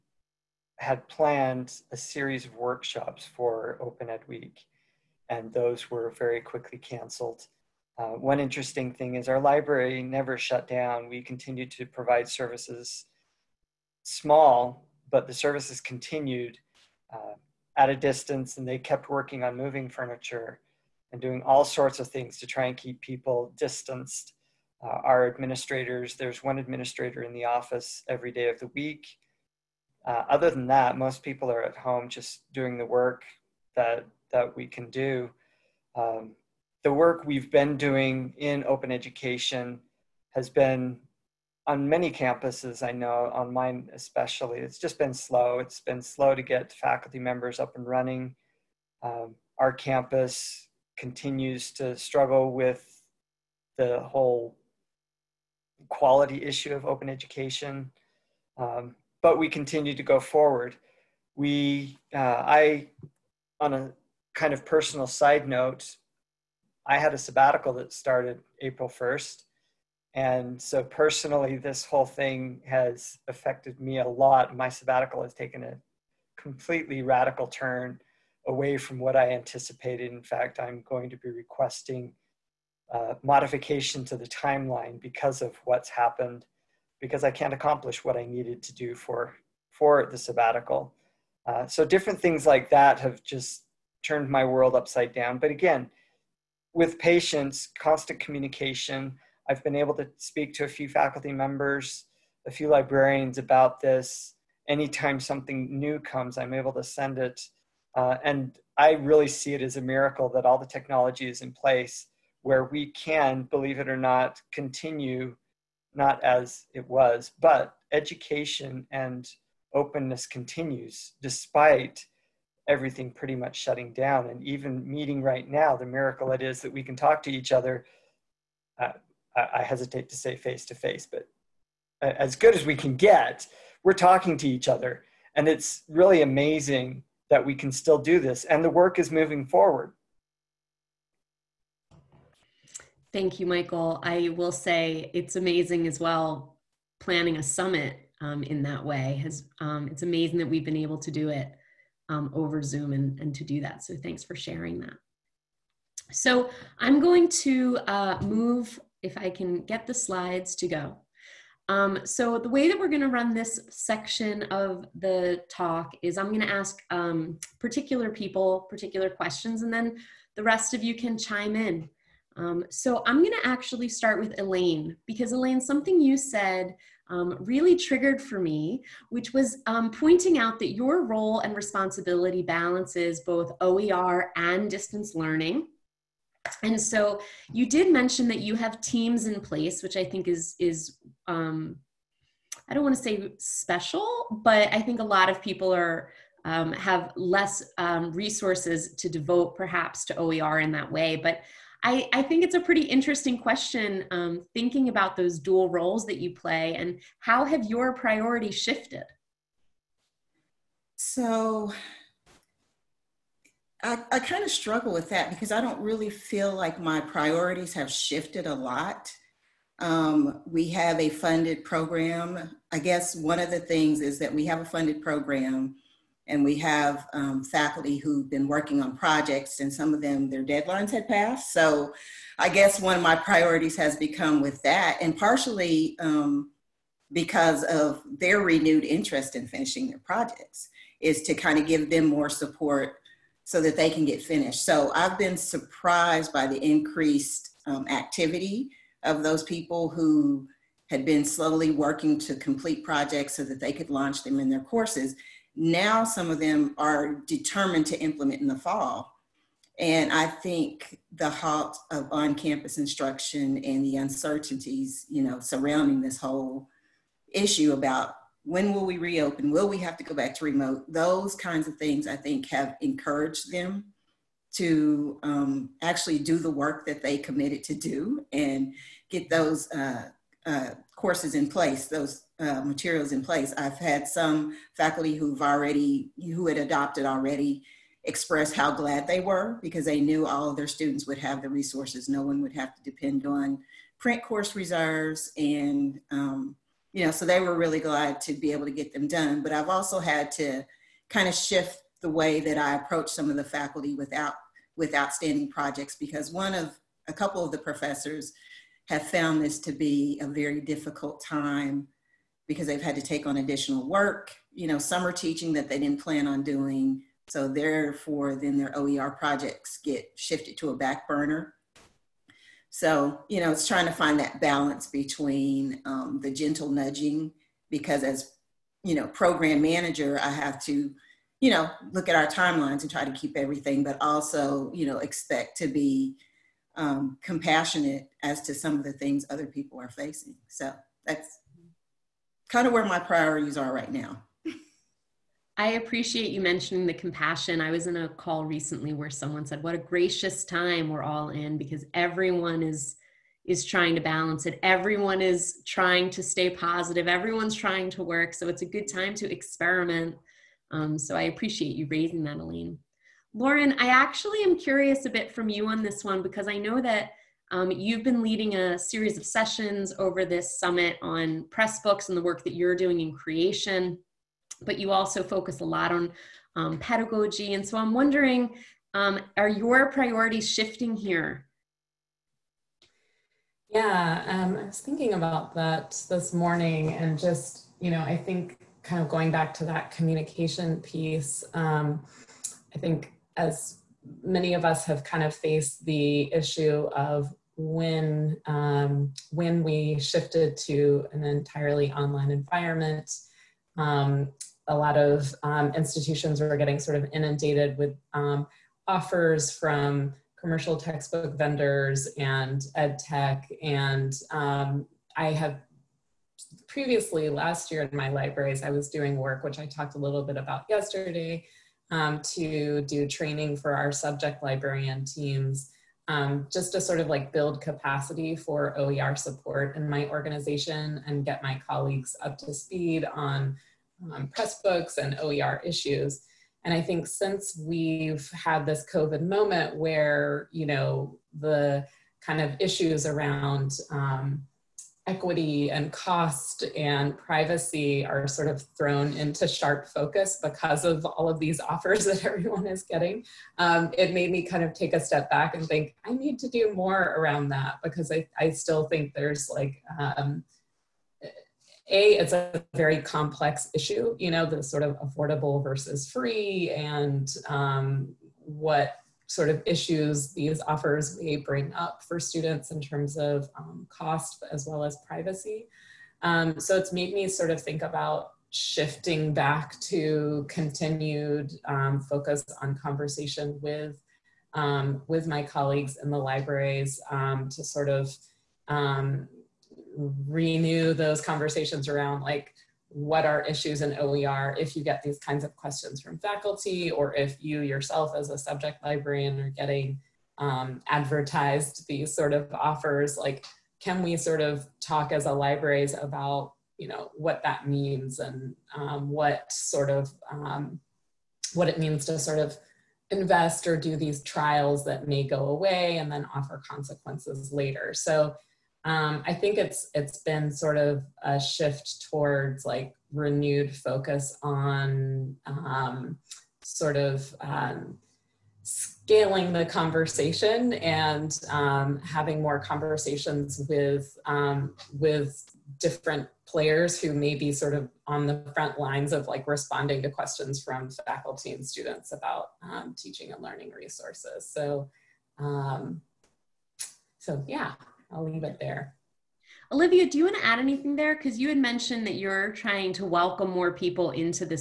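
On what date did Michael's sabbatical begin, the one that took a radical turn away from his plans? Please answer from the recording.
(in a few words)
April 1st.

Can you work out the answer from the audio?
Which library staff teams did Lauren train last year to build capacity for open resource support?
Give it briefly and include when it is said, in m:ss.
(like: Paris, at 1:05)
subject librarian teams, at 7:03.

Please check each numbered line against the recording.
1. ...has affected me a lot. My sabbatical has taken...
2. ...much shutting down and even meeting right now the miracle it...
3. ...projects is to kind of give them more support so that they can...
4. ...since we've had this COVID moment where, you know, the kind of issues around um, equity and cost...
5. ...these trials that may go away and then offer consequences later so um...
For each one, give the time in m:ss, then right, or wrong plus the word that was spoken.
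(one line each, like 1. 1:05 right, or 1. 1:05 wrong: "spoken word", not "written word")
1. 1:12 right
2. 2:03 right
3. 3:59 right
4. 7:17 right
5. 8:33 right.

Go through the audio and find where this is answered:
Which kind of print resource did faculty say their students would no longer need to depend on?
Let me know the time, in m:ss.
4:53.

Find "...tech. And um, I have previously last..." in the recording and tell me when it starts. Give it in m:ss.
6:52.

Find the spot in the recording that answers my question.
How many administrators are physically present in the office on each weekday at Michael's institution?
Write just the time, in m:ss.
0:26.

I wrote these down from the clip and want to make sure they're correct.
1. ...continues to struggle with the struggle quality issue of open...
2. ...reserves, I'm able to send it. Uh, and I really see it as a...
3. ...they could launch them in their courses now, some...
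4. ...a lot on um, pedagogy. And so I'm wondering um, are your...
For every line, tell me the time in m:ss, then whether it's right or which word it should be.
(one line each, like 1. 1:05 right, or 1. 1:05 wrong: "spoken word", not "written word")
1. 0:50 wrong: "whole", not "struggle"
2. 1:45 wrong: "comes", not "reserves"
3. 4:13 right
4. 6:15 right.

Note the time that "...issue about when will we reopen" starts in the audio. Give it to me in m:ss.
4:27.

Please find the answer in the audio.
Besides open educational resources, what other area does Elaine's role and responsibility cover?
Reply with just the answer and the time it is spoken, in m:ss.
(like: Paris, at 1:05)
distance learning, at 3:04.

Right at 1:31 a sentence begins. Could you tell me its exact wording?
Uh, so different things like that have just turned my world upside down.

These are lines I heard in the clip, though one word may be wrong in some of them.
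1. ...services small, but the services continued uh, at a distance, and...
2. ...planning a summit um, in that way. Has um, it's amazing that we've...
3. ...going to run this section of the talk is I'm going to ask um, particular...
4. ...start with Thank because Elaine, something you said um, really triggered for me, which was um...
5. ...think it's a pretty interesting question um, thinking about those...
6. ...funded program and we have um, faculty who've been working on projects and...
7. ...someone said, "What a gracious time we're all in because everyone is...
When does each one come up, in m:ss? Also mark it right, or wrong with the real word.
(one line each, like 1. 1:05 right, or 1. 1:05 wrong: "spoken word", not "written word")
1. 0:12 right
2. 2:26 right
3. 2:42 right
4. 2:53 wrong: "Elaine", not "Thank"
5. 3:22 right
6. 3:44 right
7. 5:49 right.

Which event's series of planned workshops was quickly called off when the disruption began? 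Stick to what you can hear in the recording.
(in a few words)
Open Ed Week.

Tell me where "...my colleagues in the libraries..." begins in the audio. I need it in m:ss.
8:05.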